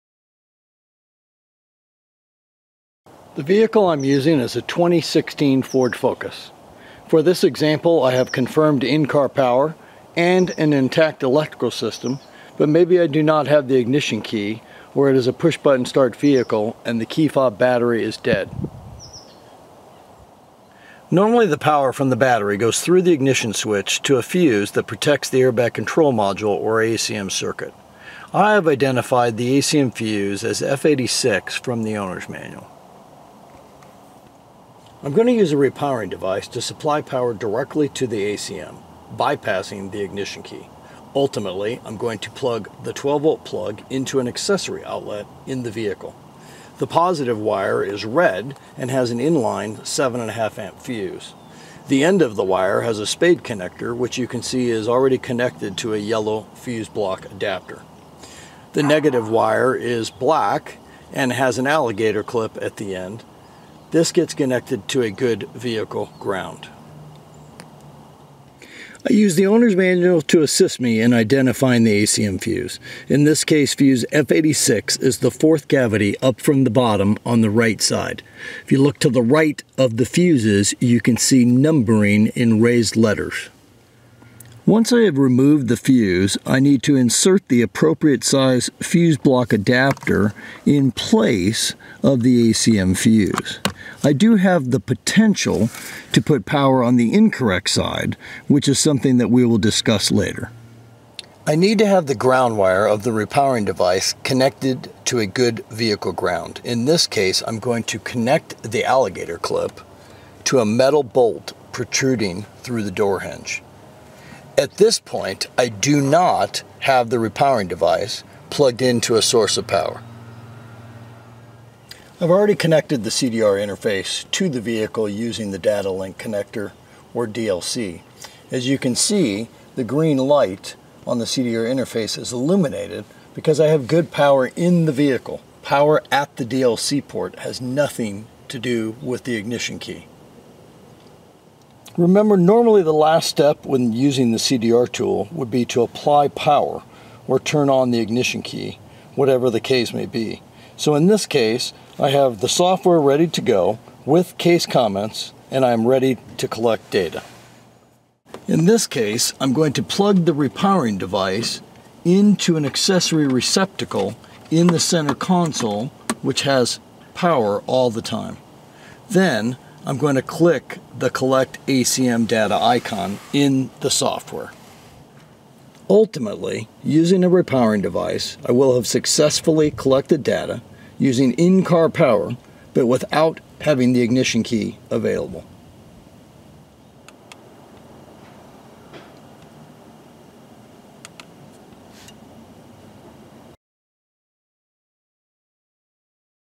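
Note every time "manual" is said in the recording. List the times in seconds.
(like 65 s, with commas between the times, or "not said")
32 s, 69 s.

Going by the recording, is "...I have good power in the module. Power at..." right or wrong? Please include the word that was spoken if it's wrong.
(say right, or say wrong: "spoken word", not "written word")
wrong: "vehicle", not "module".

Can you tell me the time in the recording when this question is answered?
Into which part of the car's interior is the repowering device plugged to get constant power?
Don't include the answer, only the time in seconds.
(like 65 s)
164 s.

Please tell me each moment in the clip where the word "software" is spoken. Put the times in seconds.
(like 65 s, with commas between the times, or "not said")
152 s, 173 s.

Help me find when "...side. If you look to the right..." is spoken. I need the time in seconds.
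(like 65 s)
77 s.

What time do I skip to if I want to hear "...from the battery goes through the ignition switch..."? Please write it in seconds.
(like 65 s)
21 s.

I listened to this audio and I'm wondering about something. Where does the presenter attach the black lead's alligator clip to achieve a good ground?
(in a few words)
door hinge.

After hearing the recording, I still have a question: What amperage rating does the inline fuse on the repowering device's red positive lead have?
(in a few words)
7.5 amp.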